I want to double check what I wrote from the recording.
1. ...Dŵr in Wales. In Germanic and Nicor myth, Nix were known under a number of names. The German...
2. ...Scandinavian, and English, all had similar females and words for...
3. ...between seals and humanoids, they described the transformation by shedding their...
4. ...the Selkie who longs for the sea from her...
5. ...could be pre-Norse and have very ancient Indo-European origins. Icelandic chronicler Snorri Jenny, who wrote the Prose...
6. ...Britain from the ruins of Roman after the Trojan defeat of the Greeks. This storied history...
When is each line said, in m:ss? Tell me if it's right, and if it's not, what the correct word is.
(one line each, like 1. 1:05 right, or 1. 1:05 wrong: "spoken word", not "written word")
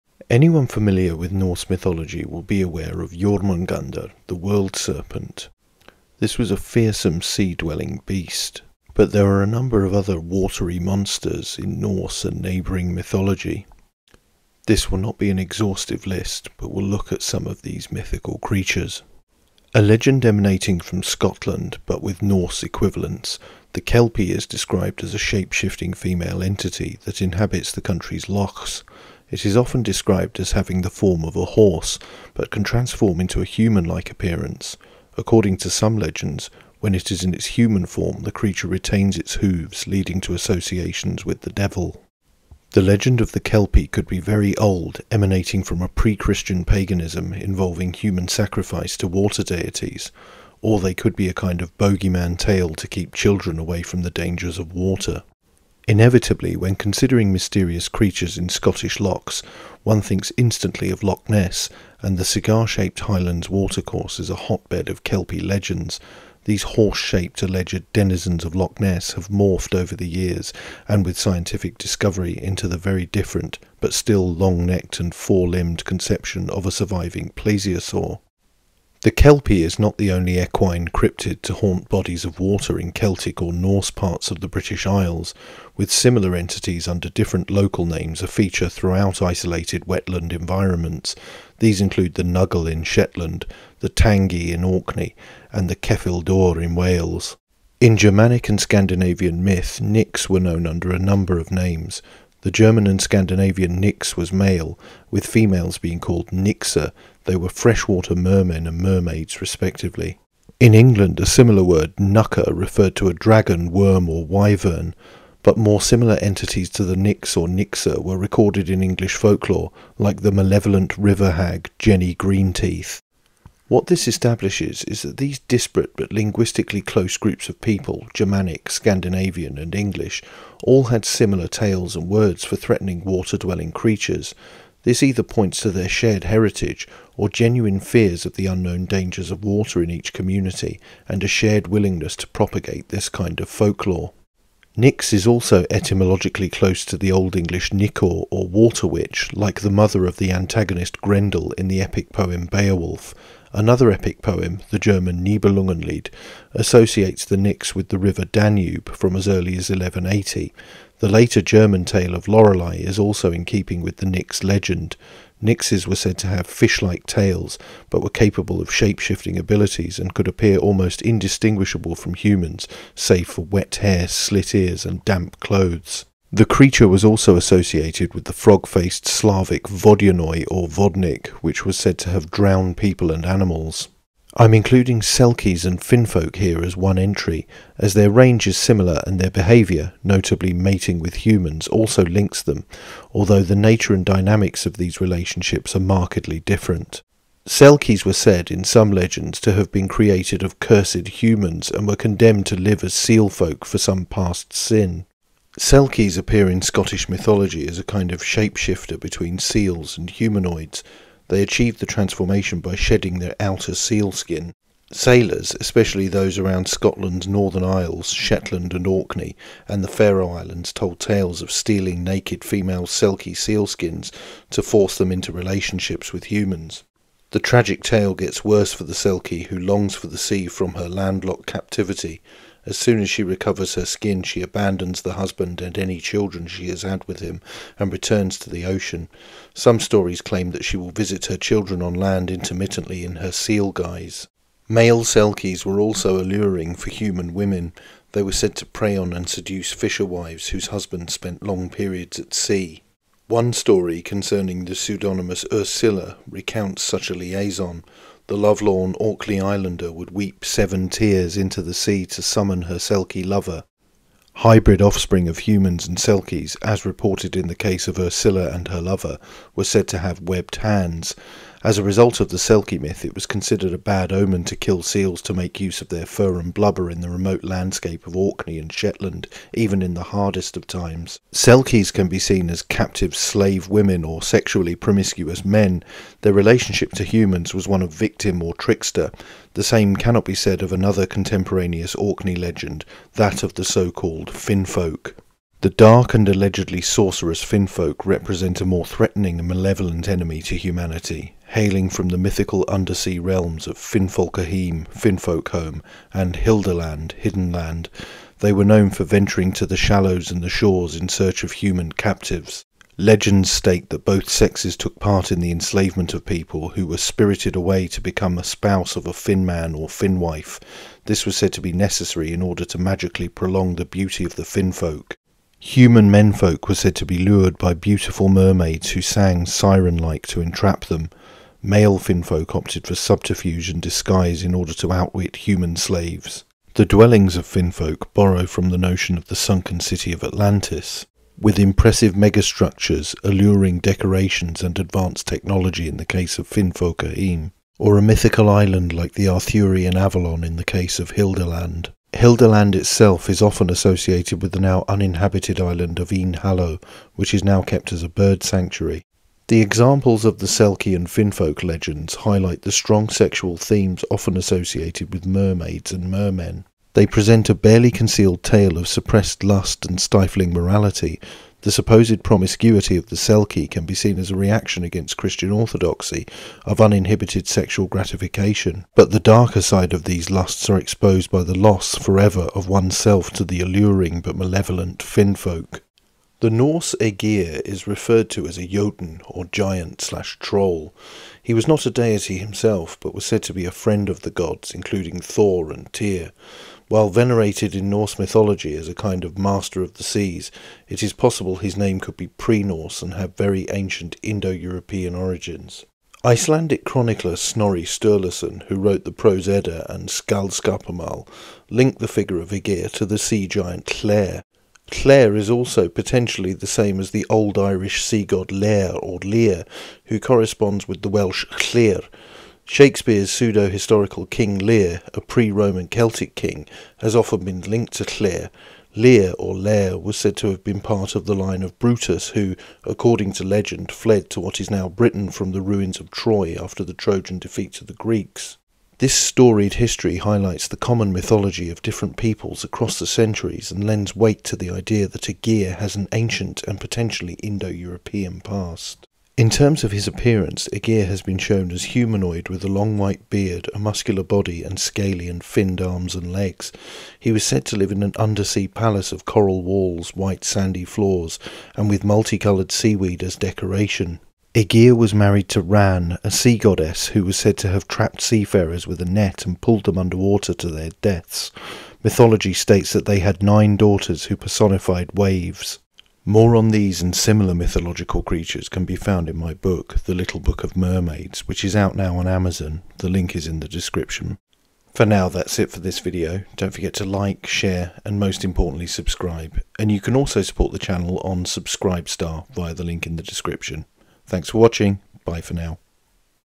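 1. 1:36 wrong: "Scandinavian", not "Nicor"
2. 2:08 wrong: "tales", not "females"
3. 3:28 wrong: "achieved", not "described"
4. 3:48 right
5. 6:42 wrong: "Sturluson", not "Jenny"
6. 7:14 wrong: "Troy", not "Roman".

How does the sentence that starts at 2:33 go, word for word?
Another epic poem, the German Nibelungenlied, associates the Nix with the river Danube from as early as 1180.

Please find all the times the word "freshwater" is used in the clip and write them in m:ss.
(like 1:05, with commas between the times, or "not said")
1:47.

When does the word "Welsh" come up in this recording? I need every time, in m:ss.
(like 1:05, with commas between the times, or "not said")
7:01.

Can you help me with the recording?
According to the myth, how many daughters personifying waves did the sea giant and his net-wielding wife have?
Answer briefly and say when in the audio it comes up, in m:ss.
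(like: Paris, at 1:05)
9, at 7:53.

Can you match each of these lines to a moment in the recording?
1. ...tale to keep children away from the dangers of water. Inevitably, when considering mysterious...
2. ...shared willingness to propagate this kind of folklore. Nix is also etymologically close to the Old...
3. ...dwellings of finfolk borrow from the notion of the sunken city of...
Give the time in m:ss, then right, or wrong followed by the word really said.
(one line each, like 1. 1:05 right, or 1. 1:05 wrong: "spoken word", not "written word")
1. 0:52 right
2. 2:21 right
3. 5:36 right.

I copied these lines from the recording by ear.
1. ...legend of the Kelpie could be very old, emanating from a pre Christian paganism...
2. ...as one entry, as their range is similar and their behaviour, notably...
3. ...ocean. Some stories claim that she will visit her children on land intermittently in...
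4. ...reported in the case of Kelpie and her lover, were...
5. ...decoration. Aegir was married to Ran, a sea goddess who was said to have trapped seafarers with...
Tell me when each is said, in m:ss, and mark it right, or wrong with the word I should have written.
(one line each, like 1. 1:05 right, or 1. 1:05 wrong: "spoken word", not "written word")
1. 0:42 right
2. 3:06 right
3. 3:58 right
4. 4:26 wrong: "Ursula", not "Kelpie"
5. 7:43 right.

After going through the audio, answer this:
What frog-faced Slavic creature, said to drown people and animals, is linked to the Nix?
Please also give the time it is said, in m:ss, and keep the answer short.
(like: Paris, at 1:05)
Vodyanoi, at 2:59.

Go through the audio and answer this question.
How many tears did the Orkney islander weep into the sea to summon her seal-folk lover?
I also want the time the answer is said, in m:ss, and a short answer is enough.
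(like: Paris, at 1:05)
7, at 4:20.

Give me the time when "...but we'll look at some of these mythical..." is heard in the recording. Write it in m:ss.
0:16.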